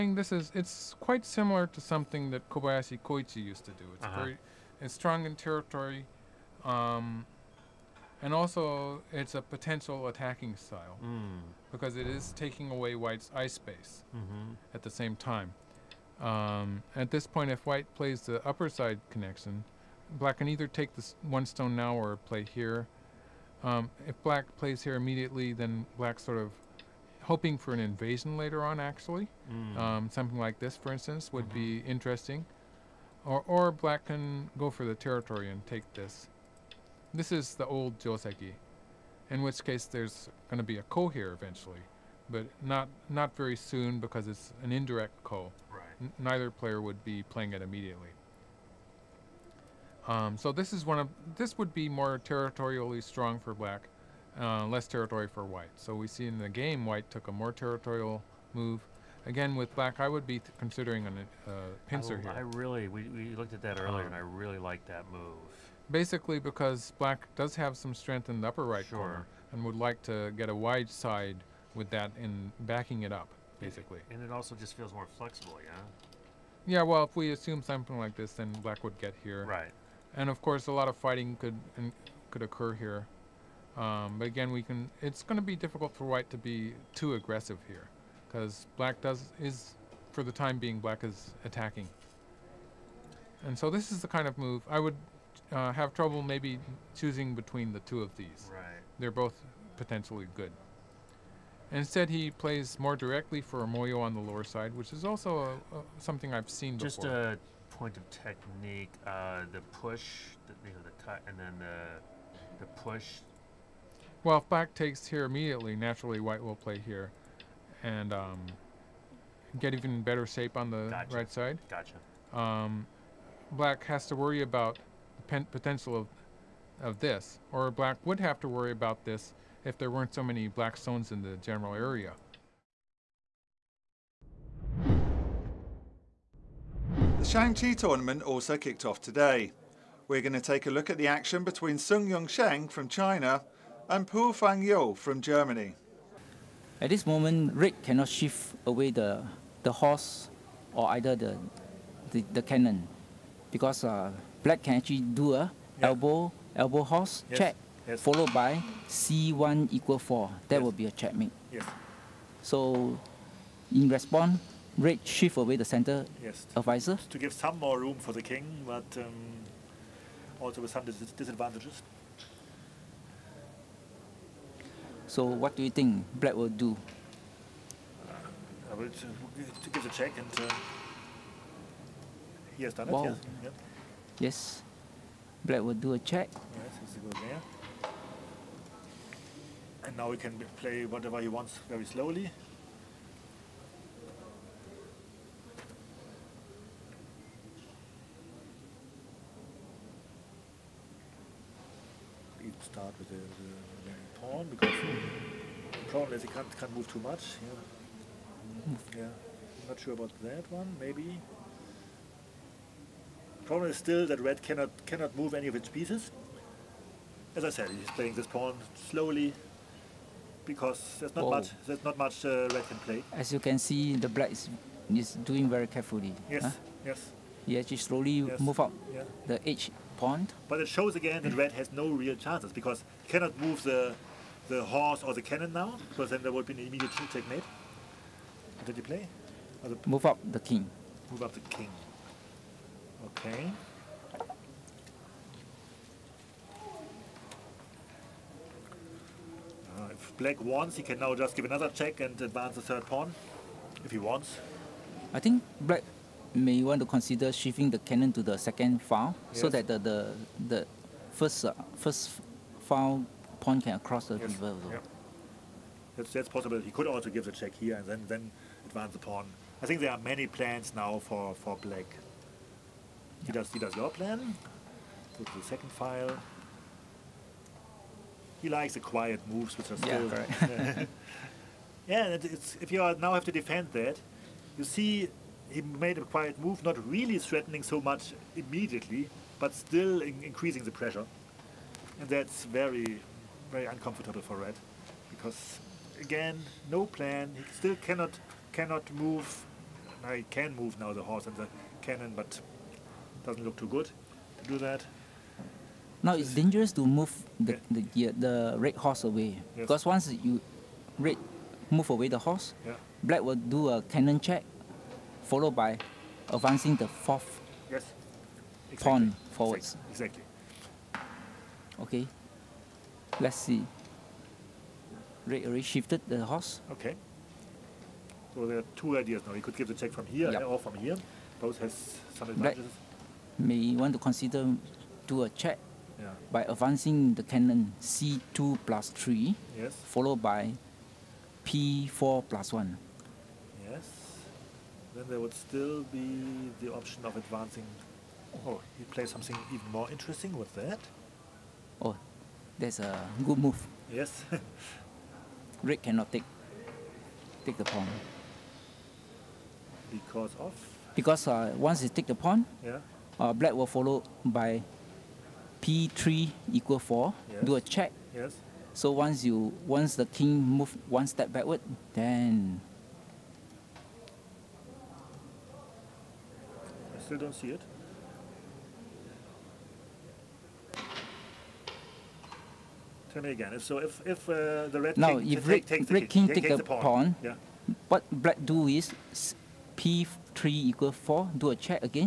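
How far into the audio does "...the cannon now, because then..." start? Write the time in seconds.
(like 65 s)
235 s.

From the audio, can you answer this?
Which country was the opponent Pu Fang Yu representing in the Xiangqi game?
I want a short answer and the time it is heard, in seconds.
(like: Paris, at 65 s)
Germany, at 145 s.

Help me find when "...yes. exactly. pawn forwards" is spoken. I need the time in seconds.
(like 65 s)
317 s.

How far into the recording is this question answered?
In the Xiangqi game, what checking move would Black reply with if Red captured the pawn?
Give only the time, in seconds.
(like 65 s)
365 s.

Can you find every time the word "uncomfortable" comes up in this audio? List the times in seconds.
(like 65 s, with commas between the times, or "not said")
293 s.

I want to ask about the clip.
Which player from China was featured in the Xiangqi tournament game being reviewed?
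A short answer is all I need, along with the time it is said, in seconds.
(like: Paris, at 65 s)
Sung Yung Sheng, at 141 s.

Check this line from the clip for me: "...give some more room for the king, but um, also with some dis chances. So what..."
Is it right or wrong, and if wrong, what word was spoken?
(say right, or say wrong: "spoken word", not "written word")
wrong: "disadvantages", not "chances".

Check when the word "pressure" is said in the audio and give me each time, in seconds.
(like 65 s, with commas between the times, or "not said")
290 s.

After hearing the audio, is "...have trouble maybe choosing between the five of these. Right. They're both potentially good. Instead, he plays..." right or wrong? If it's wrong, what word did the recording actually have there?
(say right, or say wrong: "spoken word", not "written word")
wrong: "two", not "five".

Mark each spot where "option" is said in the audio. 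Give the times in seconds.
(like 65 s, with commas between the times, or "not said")
346 s.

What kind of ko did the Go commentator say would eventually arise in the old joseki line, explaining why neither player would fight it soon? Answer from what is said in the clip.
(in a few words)
indirect ko.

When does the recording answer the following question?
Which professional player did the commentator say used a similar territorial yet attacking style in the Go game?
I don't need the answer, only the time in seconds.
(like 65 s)
2 s.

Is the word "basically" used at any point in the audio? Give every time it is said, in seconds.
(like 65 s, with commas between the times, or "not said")
65 s, 73 s.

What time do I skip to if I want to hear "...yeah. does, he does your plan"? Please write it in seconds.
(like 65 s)
273 s.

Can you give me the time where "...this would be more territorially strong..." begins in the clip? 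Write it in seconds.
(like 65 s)
51 s.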